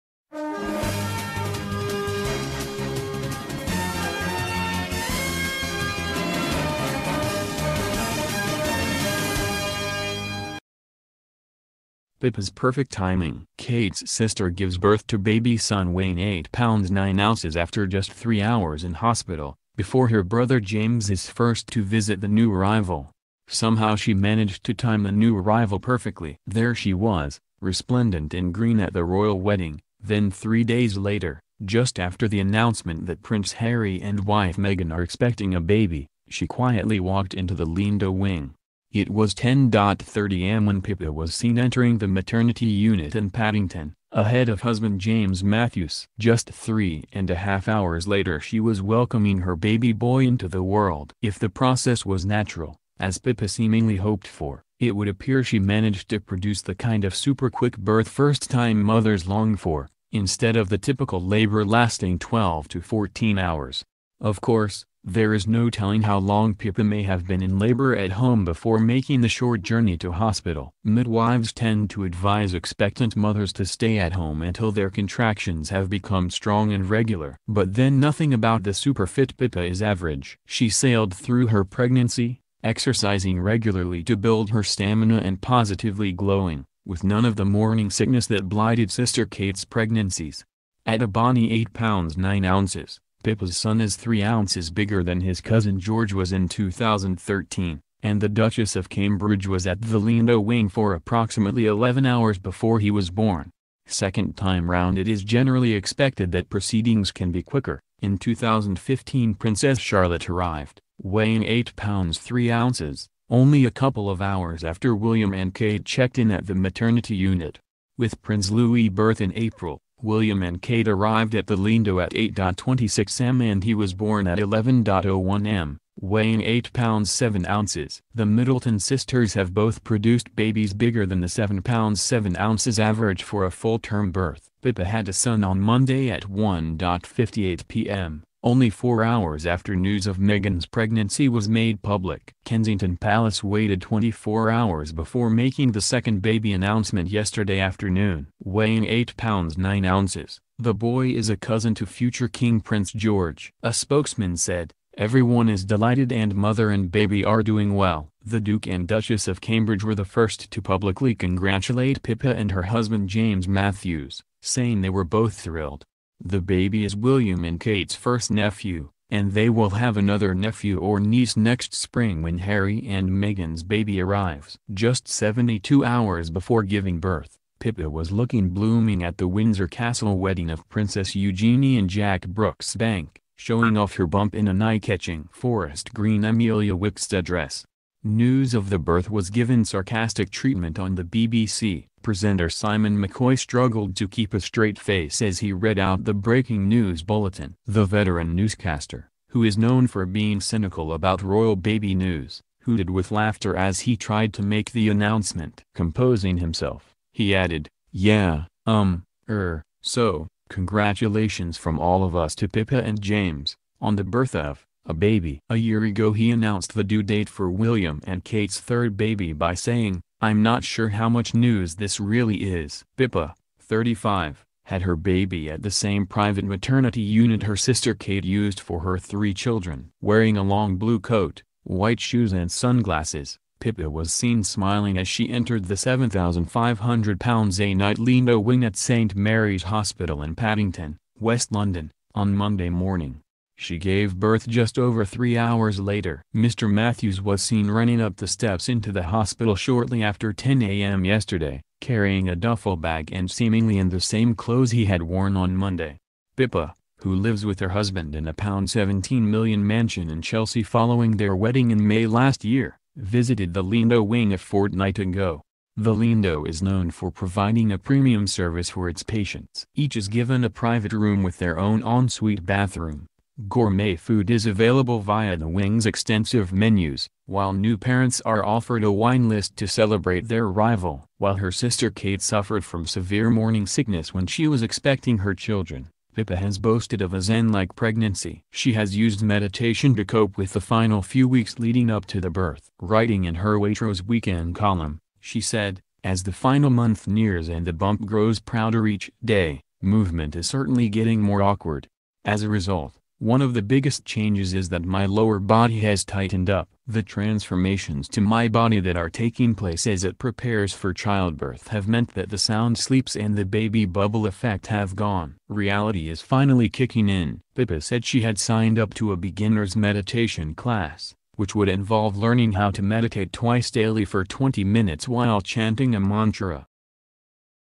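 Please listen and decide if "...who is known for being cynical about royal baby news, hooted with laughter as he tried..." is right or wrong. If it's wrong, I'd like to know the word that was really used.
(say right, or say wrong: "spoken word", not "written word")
right.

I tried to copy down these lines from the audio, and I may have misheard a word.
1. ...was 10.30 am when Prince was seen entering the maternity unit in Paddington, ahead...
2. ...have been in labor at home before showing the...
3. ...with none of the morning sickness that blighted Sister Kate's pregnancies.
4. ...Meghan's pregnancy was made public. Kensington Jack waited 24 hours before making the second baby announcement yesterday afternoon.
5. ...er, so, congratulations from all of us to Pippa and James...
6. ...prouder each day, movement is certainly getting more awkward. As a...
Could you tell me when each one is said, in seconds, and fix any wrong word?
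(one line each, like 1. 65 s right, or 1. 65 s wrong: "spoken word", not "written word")
1. 39 s wrong: "Pippa", not "Prince"
2. 67 s wrong: "making", not "showing"
3. 86 s right
4. 140 s wrong: "Palace", not "Jack"
5. 209 s right
6. 298 s right.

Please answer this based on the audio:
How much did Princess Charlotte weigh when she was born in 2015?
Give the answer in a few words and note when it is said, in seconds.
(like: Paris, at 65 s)
8 pounds 3 ounces, at 111 s.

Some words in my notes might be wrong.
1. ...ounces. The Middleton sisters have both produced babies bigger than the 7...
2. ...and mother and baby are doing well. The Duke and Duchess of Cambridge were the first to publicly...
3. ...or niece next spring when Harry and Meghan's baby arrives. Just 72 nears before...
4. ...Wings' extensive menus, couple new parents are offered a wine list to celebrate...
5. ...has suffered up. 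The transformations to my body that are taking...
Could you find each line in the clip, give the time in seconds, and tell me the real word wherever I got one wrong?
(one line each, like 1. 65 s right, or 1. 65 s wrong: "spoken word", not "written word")
1. 127 s right
2. 156 s right
3. 170 s wrong: "hours", not "nears"
4. 275 s wrong: "while", not "couple"
5. 305 s wrong: "tightened", not "suffered".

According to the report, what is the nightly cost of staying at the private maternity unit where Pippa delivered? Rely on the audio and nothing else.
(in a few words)
£7,500.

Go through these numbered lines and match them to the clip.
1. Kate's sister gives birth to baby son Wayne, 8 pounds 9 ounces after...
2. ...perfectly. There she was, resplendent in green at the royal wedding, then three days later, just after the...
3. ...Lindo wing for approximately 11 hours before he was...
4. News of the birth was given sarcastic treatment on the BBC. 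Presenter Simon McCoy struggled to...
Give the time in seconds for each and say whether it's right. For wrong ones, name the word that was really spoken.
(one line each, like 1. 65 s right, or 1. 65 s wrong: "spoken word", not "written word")
1. 13 s right
2. 25 s right
3. 100 s right
4. 188 s right.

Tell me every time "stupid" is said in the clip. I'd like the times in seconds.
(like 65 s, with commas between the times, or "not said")
not said.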